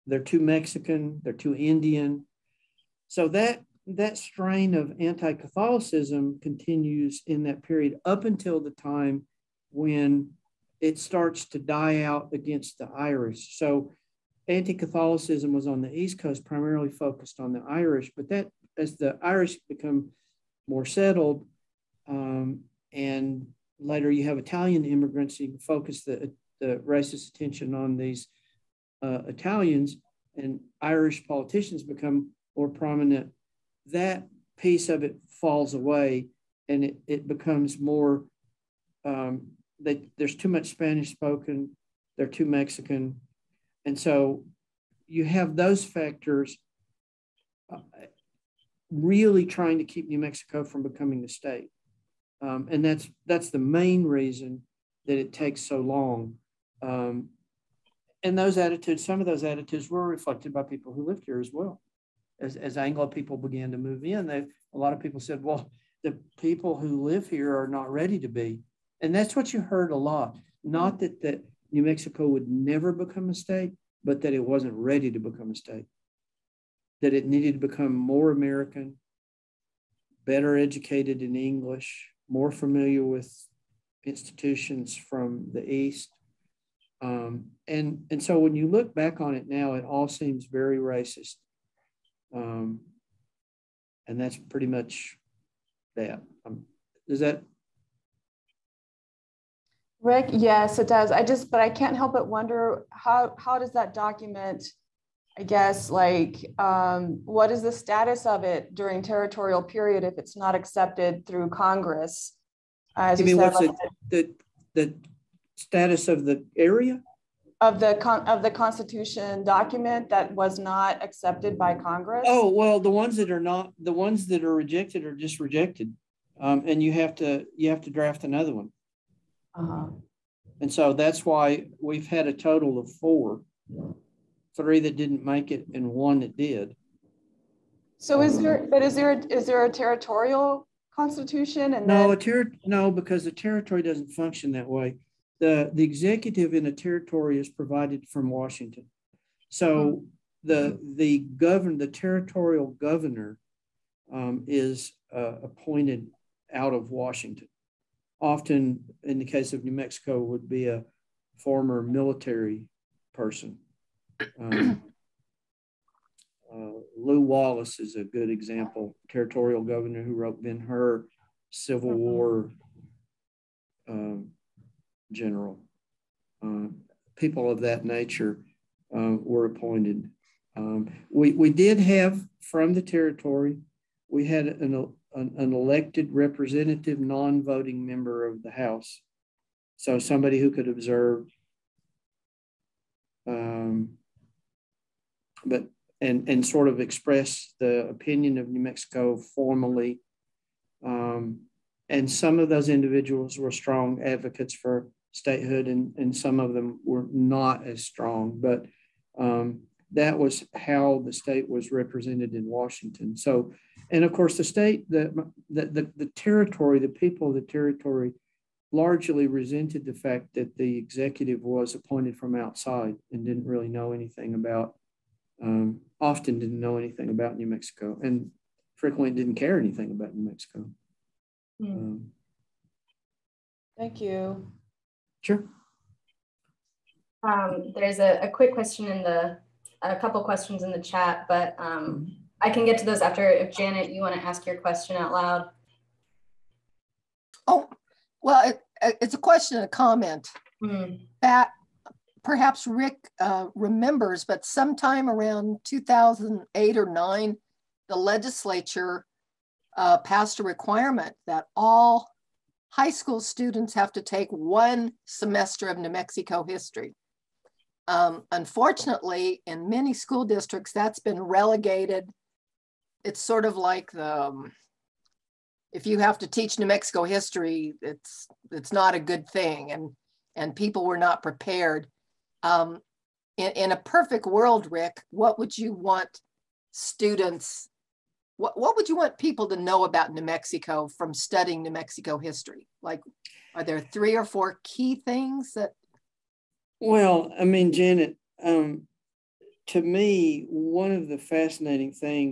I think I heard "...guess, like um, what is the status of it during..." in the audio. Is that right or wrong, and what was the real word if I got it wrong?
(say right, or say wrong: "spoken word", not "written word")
right.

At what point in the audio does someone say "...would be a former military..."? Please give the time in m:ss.
2:40.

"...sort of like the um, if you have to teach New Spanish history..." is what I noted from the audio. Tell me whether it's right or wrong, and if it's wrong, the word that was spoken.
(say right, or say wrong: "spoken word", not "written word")
wrong: "Mexico", not "Spanish".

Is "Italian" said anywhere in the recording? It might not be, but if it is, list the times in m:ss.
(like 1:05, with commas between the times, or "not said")
0:24, 0:29.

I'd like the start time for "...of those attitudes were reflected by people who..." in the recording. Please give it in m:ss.
0:59.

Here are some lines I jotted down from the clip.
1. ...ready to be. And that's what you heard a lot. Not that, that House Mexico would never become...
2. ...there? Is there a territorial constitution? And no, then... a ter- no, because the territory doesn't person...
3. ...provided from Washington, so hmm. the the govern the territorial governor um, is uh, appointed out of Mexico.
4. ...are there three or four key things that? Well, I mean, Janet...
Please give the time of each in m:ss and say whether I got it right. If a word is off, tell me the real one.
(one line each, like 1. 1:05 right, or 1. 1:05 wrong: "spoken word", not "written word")
1. 1:07 wrong: "New", not "House"
2. 2:18 wrong: "function", not "person"
3. 2:27 wrong: "Washington", not "Mexico"
4. 4:53 right.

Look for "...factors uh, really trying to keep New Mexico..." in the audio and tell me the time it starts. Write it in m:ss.
0:45.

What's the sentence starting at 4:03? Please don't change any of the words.
If Janet, you want to ask your question out loud.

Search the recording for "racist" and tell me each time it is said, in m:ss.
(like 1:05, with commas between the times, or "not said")
0:26, 1:30.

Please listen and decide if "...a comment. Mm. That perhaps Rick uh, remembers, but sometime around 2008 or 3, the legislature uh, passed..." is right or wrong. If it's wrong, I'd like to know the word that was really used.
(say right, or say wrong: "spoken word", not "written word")
wrong: "9", not "3".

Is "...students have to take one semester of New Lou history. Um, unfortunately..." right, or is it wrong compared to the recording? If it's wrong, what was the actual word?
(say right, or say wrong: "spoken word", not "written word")
wrong: "Mexico", not "Lou".